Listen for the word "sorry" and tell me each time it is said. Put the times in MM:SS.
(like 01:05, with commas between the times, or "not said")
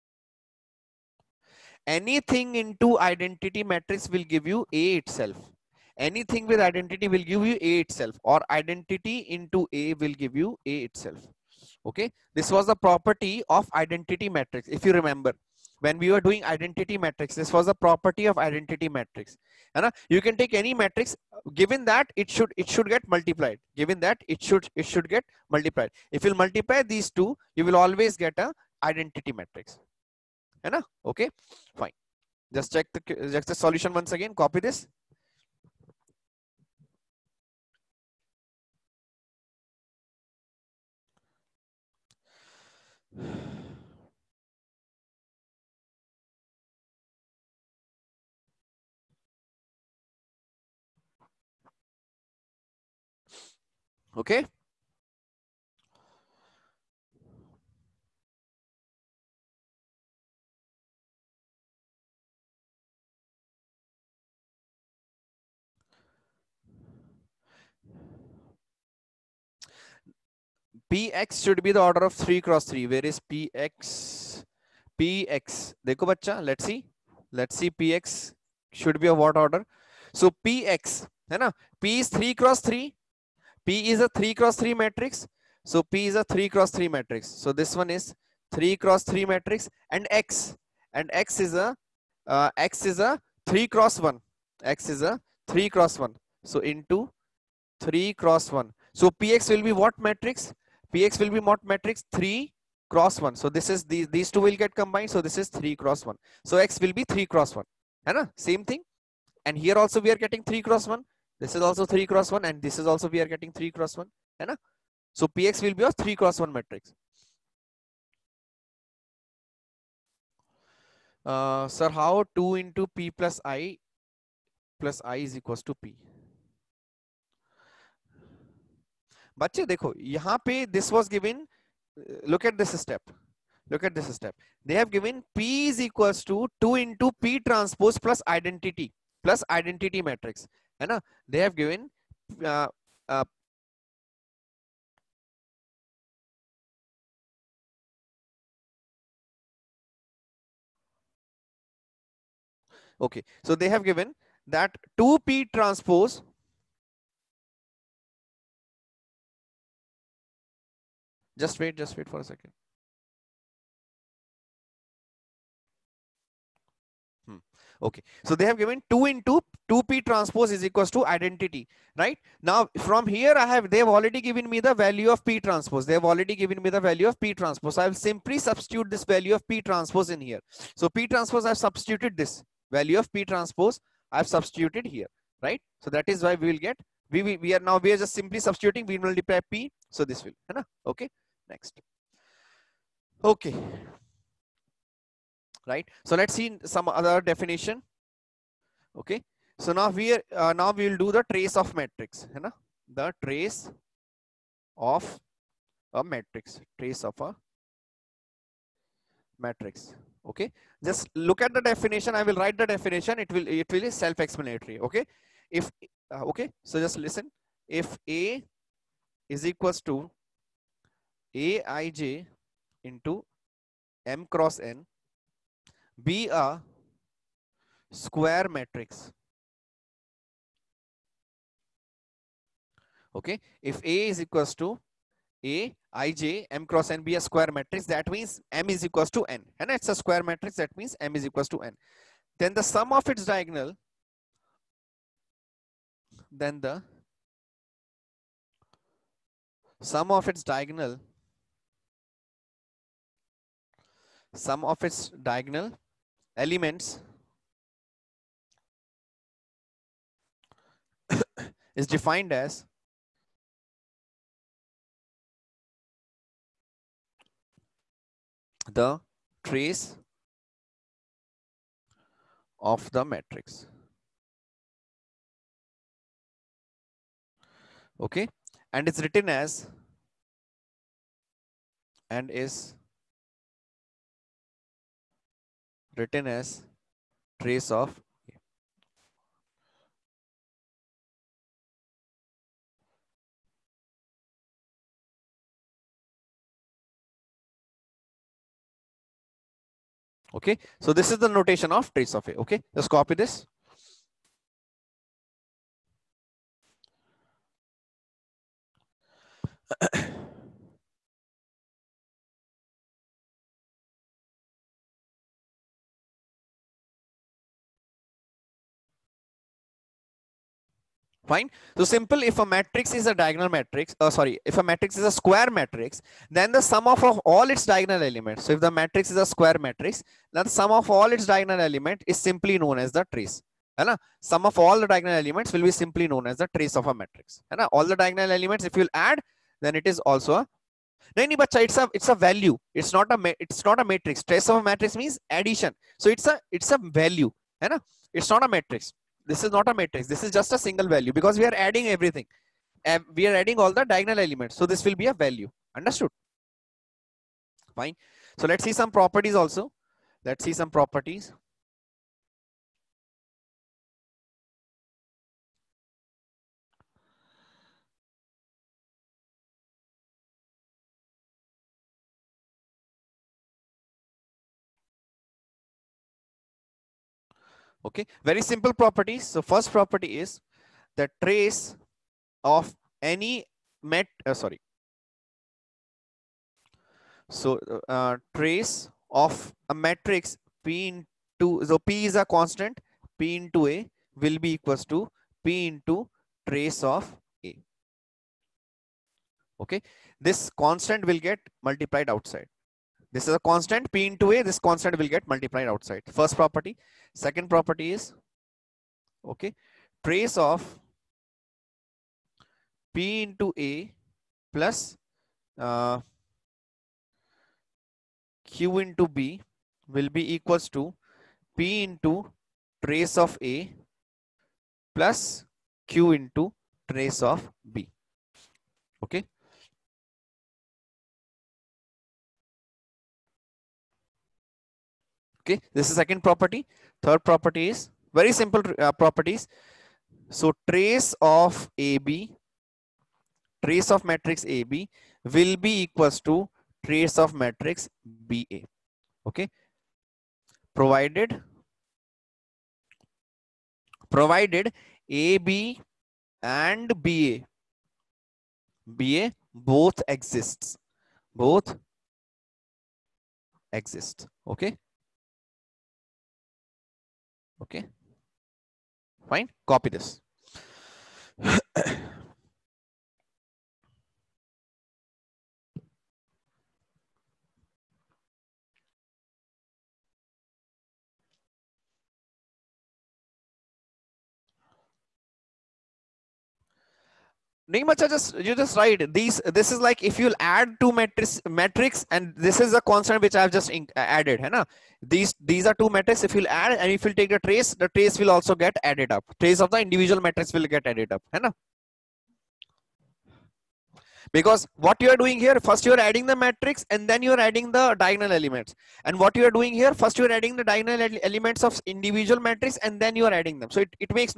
05:24, 06:24.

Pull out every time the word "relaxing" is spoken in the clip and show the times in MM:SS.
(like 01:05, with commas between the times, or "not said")
not said.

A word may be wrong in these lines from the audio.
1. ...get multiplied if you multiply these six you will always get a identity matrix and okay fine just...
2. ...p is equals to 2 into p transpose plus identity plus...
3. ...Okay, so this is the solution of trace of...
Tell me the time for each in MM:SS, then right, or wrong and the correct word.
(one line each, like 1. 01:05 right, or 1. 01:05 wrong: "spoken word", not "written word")
1. 00:25 wrong: "two", not "six"
2. 02:15 right
3. 05:00 wrong: "notation", not "solution".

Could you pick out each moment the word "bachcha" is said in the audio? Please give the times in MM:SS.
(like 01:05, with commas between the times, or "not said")
01:16.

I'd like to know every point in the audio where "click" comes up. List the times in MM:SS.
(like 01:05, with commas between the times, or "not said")
not said.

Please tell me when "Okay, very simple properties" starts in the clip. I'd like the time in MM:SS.
06:17.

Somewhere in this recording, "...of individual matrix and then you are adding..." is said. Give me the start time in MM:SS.
08:31.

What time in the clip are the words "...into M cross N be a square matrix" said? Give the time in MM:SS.
03:42.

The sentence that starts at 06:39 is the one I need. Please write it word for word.
Okay, this constant will get multiplied outside.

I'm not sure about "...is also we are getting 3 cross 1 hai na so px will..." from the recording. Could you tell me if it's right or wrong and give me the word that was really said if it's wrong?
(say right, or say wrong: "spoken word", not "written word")
right.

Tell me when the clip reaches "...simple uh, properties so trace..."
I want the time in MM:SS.
07:18.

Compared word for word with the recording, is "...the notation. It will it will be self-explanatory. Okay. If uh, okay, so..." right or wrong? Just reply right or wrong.
wrong.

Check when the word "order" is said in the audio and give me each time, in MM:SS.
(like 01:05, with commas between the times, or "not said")
01:11, 01:19.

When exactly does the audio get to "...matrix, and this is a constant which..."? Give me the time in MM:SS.
08:11.